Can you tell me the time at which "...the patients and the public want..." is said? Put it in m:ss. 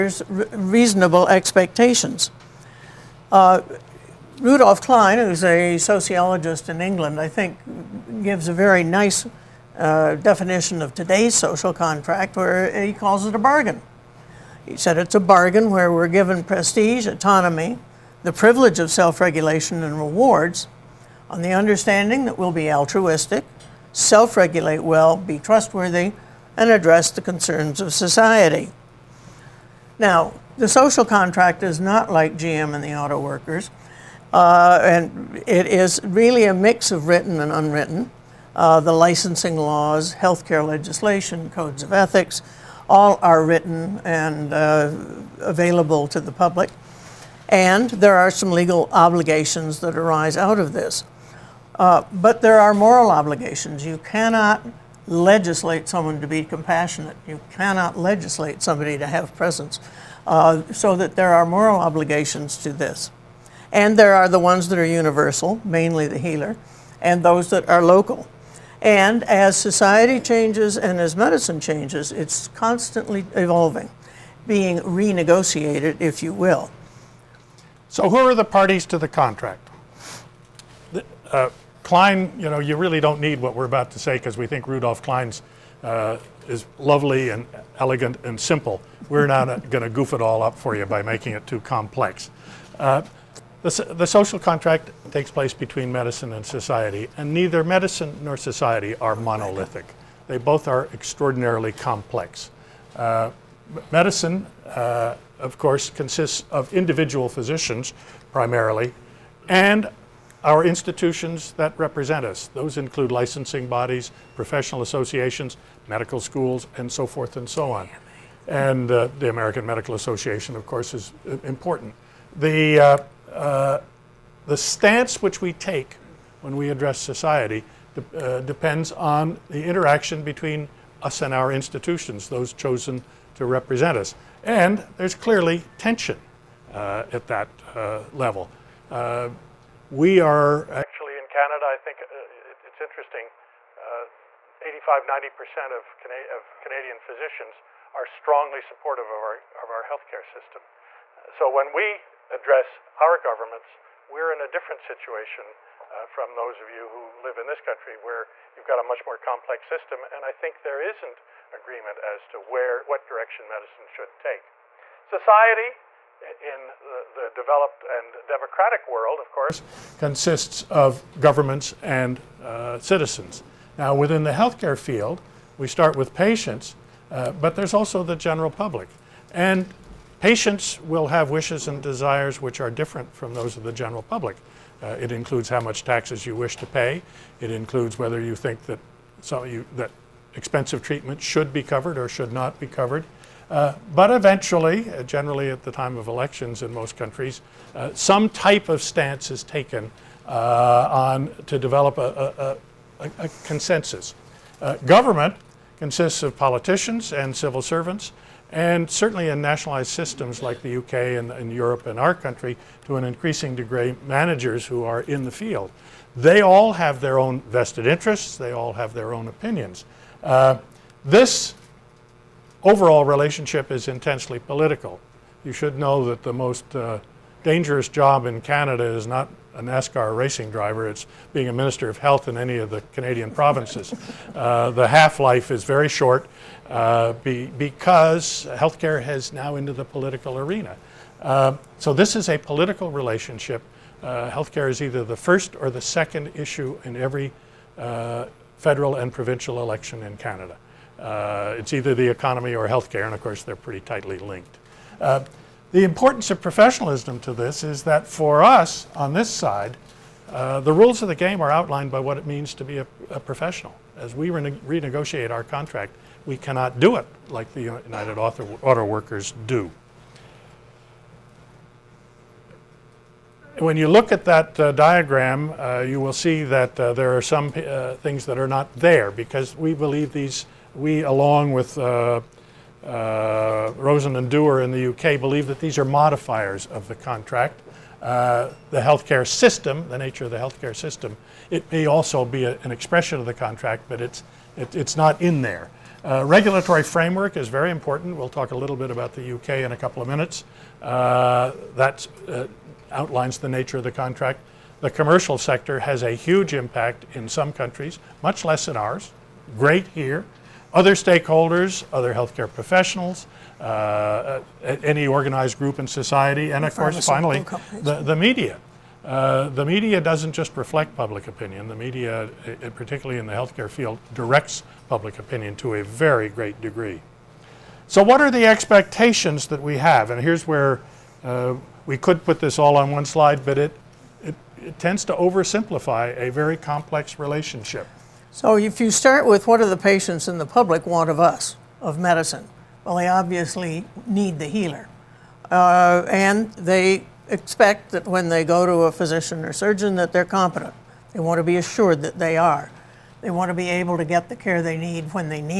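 5:39.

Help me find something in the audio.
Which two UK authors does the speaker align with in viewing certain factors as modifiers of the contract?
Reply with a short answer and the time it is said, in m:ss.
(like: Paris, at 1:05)
Rosen and Dewar, at 4:43.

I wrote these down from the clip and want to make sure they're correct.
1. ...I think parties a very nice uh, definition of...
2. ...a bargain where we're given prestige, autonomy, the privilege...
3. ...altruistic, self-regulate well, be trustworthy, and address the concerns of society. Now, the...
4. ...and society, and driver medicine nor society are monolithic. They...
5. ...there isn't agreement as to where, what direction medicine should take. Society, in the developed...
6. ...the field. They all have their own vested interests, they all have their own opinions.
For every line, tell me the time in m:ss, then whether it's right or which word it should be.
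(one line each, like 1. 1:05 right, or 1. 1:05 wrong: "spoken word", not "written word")
1. 0:07 wrong: "gives", not "parties"
2. 0:15 right
3. 0:22 right
4. 1:36 wrong: "neither", not "driver"
5. 2:40 right
6. 3:35 right.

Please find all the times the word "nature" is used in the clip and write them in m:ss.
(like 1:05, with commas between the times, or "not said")
4:49, 5:03.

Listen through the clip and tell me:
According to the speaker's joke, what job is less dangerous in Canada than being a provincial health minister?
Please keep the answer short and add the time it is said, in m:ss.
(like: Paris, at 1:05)
NASCAR racing driver, at 3:49.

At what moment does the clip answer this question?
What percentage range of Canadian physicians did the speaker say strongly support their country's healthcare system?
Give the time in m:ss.
2:24.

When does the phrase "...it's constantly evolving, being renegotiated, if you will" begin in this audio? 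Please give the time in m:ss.
1:12.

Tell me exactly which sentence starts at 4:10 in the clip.
Uh, it's either the economy or healthcare, and of course they're pretty tightly linked.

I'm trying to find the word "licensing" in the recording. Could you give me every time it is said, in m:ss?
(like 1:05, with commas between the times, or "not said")
0:38, 1:53.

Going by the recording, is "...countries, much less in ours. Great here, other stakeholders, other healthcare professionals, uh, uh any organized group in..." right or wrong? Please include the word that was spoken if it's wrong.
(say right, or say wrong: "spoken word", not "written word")
right.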